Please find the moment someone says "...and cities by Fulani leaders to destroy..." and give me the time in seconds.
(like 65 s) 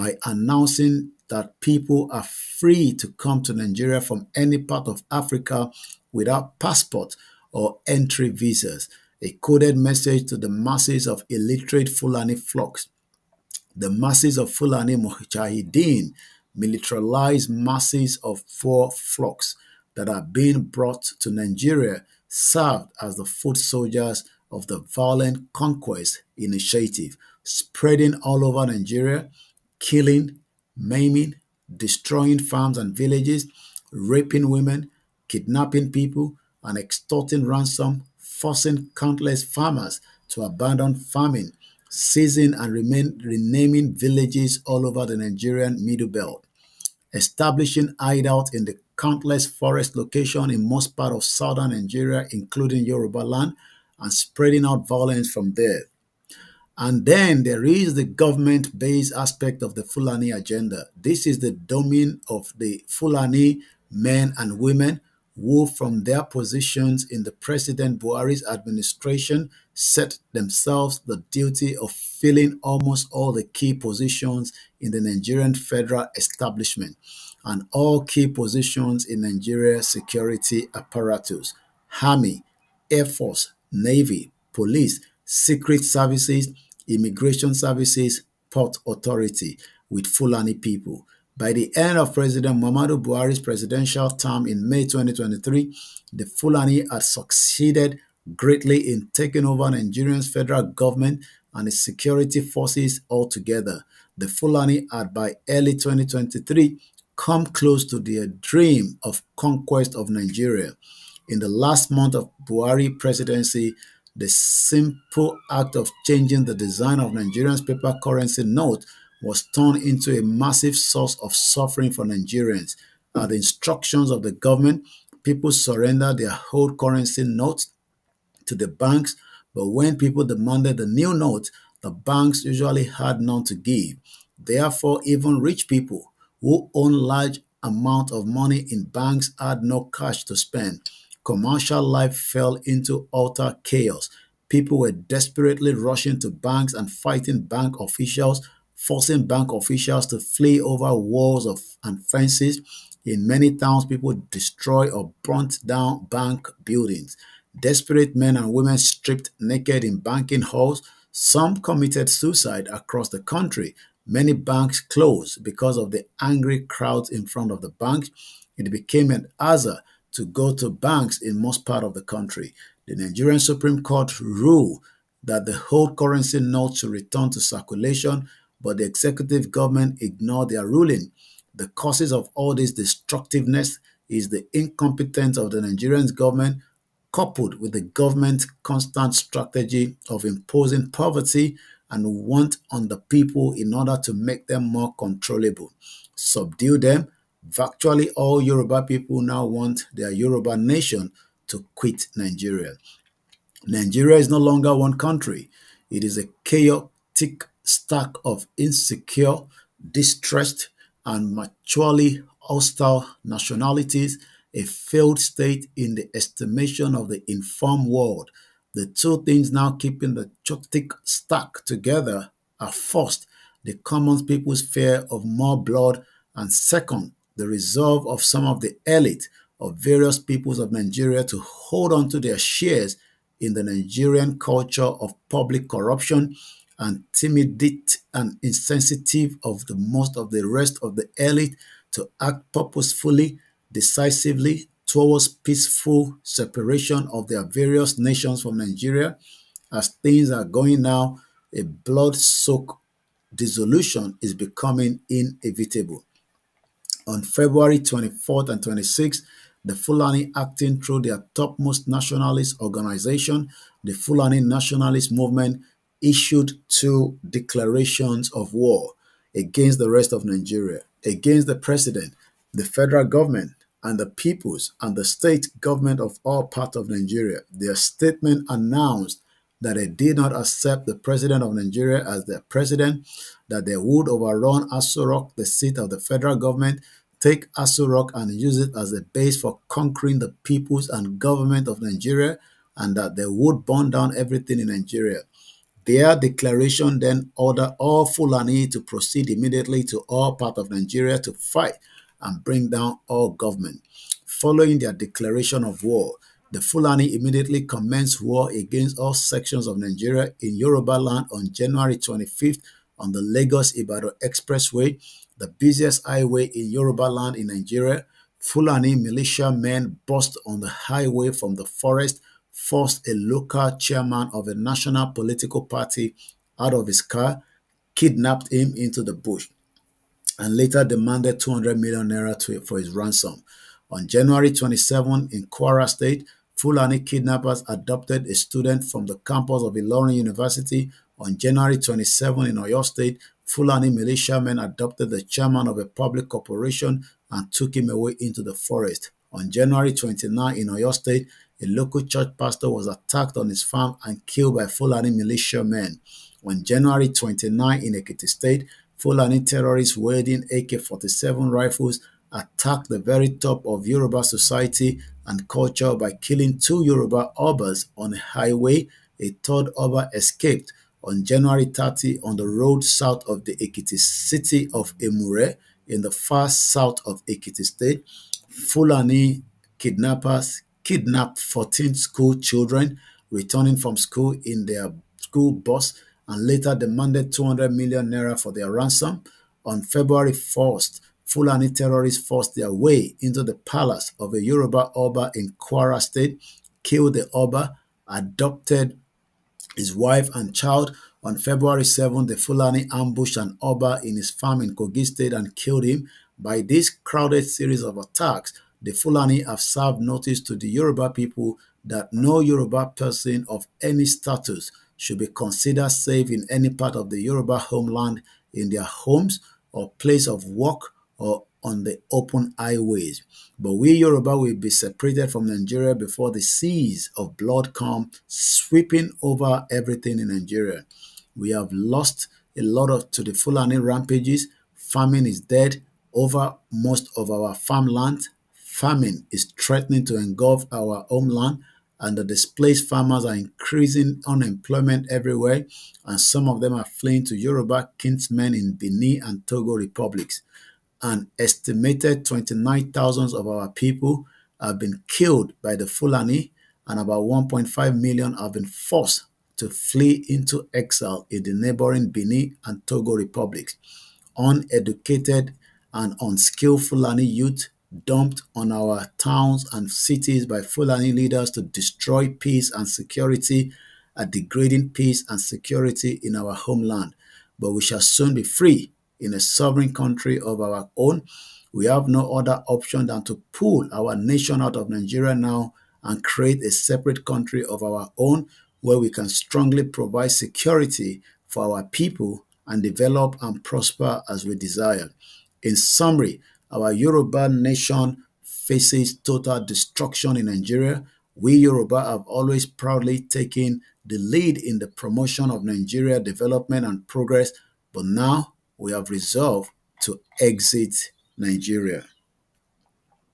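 469 s.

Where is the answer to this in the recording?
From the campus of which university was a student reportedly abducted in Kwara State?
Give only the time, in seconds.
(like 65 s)
339 s.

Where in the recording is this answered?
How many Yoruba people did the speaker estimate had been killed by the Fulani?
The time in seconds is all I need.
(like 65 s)
452 s.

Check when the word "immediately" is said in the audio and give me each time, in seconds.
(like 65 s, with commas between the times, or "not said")
299 s, 307 s.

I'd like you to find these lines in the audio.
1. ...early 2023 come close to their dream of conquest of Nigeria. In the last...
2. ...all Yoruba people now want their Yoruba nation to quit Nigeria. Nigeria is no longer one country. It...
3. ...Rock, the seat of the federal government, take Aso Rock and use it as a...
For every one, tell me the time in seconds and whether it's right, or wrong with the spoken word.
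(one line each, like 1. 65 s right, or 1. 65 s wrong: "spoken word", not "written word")
1. 105 s right
2. 198 s right
3. 285 s right.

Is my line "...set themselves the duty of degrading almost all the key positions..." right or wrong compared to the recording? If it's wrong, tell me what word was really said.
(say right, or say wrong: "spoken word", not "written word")
wrong: "filling", not "degrading".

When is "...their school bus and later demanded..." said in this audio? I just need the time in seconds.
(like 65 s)
384 s.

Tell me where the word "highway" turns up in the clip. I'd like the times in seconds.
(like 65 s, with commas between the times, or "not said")
316 s, 320 s, 368 s, 422 s.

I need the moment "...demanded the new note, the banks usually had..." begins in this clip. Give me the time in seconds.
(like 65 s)
130 s.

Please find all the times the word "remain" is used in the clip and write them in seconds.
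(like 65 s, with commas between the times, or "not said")
42 s.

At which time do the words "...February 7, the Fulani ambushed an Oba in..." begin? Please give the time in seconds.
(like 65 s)
401 s.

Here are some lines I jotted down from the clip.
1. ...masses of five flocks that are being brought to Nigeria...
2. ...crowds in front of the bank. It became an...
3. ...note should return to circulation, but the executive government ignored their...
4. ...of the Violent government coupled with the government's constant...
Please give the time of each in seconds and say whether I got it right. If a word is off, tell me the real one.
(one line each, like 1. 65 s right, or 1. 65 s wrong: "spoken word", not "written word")
1. 17 s wrong: "four", not "five"
2. 166 s right
3. 176 s right
4. 185 s wrong: "Nigerian", not "Violent".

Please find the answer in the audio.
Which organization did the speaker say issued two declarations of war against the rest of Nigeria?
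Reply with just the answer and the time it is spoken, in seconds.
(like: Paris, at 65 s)
Fulani Nationalist Movement, at 263 s.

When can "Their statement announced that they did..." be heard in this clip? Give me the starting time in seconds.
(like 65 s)
277 s.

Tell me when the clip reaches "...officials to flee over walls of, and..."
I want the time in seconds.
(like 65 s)
149 s.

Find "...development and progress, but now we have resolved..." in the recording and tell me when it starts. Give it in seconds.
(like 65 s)
506 s.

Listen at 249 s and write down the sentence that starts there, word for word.
As things are going now, a blood-soaked dissolution is becoming inevitable.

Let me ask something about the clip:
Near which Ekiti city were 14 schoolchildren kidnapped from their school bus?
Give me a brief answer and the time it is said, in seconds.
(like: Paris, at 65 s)
Emure, at 374 s.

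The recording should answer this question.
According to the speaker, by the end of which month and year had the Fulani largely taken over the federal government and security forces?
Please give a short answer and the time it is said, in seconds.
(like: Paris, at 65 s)
May 2023, at 94 s.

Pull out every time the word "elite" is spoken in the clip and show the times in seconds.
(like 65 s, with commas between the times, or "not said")
228 s, 241 s.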